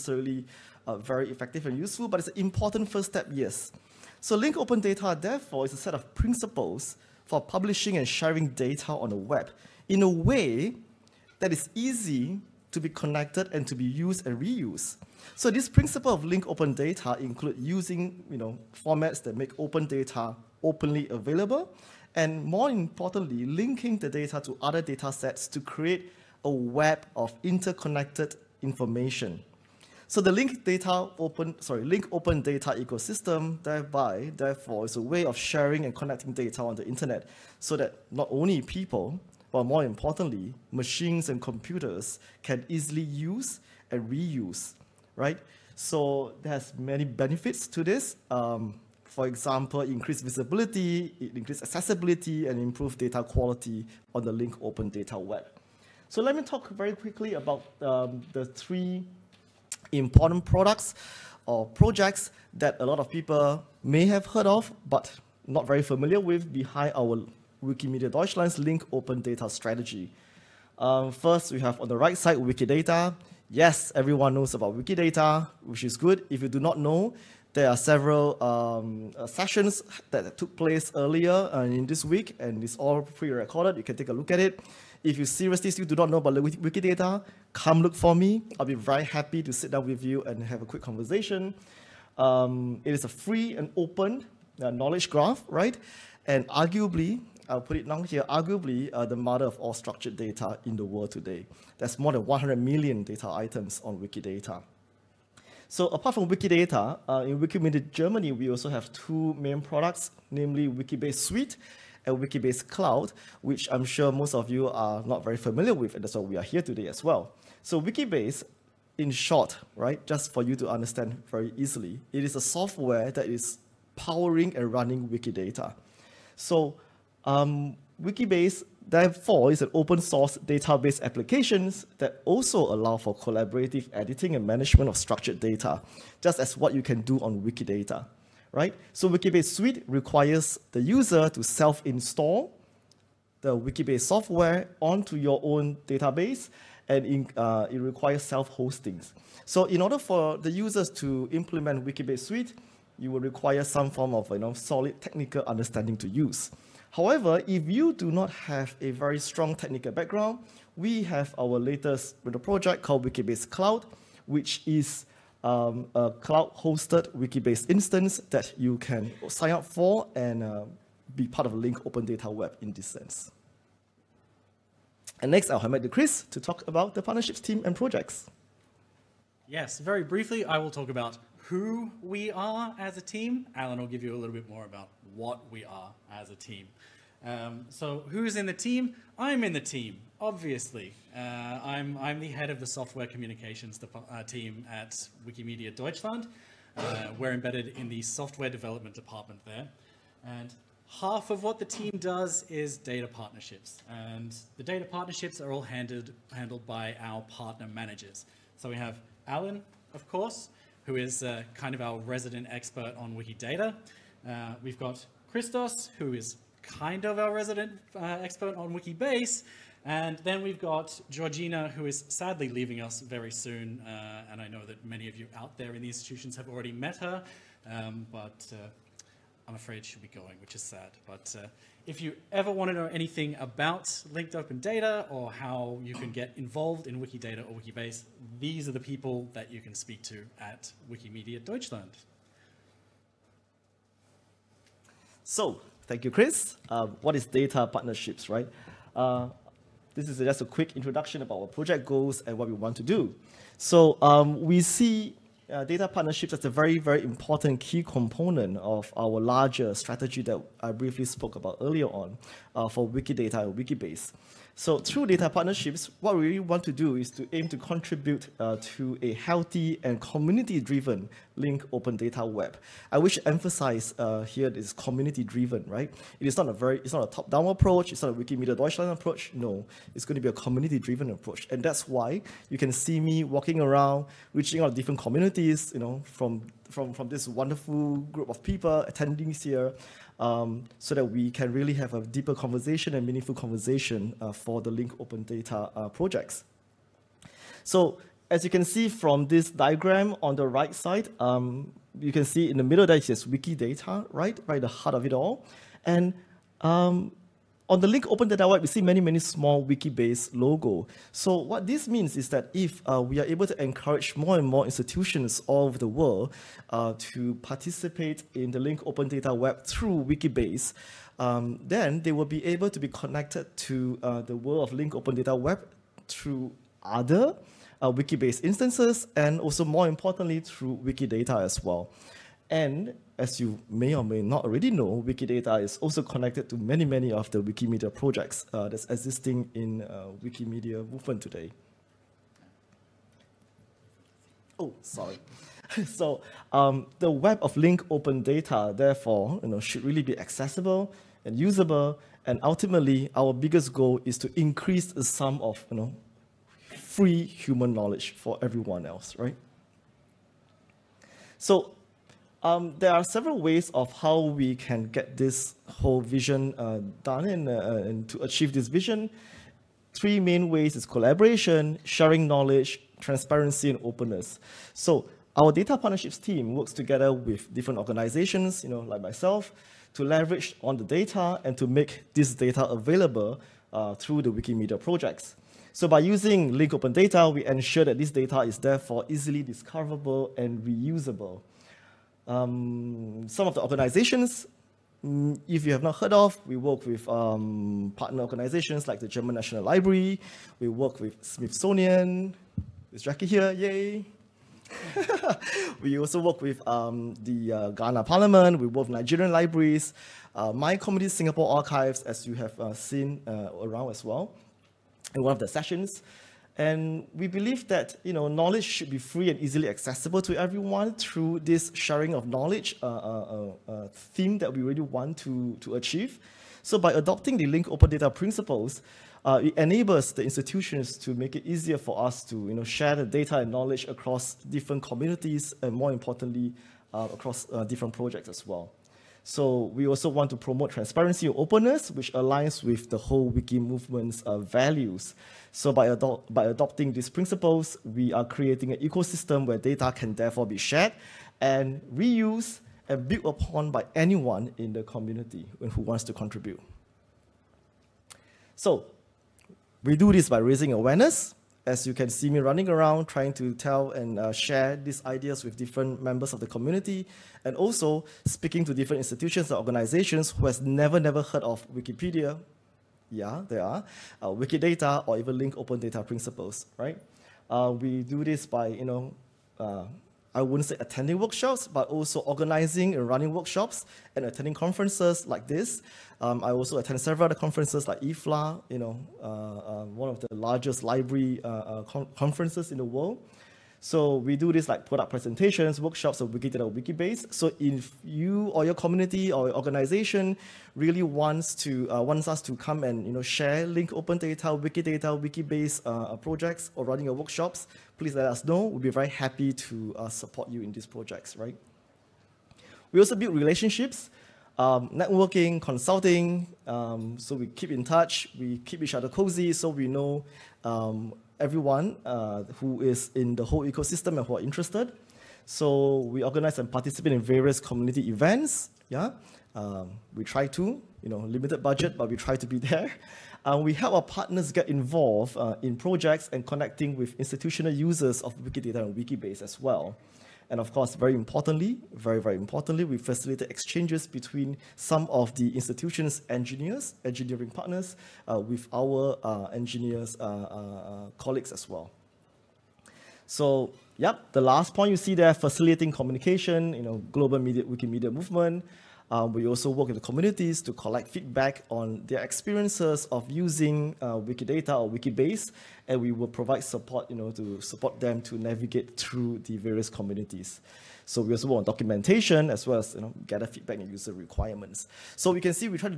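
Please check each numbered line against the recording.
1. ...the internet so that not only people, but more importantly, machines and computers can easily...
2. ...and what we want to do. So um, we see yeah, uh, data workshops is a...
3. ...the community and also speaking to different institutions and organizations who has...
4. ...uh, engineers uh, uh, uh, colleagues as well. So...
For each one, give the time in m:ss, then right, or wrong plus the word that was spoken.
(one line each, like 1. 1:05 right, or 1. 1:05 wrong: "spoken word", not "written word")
1. 0:36 right
2. 4:12 wrong: "partnerships", not "workshops"
3. 7:46 right
4. 9:09 right.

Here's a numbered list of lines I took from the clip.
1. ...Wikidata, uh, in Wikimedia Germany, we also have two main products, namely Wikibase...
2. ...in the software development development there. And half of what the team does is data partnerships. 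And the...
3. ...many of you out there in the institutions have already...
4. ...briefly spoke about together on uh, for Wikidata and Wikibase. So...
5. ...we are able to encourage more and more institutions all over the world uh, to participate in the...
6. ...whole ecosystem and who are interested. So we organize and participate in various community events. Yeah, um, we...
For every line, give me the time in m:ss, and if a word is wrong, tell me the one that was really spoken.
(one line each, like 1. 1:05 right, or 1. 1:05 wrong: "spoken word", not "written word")
1. 1:46 right
2. 3:17 wrong: "department", not "development"
3. 3:44 right
4. 4:20 wrong: "earlier", not "together"
5. 5:13 right
6. 8:43 right.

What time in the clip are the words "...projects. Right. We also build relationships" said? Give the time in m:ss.
8:30.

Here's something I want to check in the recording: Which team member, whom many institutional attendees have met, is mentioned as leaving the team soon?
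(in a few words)
Georgina.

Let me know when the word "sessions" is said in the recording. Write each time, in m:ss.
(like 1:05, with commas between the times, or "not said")
1:19, 6:55.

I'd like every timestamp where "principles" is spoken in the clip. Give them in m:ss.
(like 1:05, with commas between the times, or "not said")
0:06, 0:15, 7:08, 7:27, 7:56.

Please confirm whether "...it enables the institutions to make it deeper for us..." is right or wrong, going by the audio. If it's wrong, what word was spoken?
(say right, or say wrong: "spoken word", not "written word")
wrong: "easier", not "deeper".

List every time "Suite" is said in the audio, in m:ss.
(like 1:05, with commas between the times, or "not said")
1:51, 2:19, 2:32.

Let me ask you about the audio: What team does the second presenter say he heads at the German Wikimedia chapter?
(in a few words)
Software communications.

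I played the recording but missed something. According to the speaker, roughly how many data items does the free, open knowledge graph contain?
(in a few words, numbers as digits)
More than 100 million.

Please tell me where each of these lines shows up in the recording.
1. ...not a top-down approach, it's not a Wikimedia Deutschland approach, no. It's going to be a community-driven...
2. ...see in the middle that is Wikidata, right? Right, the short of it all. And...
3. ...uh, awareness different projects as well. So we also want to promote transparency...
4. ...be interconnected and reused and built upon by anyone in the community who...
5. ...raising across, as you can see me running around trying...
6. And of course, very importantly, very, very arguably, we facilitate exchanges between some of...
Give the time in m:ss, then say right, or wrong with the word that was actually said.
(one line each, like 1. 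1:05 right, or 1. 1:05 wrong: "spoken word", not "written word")
1. 4:36 right
2. 5:02 wrong: "heart", not "short"
3. 7:16 wrong: "across", not "awareness"
4. 7:30 wrong: "shared", not "interconnected"
5. 7:40 wrong: "awareness", not "across"
6. 9:00 wrong: "importantly", not "arguably".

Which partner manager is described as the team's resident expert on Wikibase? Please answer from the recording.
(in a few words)
Christos.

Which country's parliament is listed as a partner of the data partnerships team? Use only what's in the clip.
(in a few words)
Ghana.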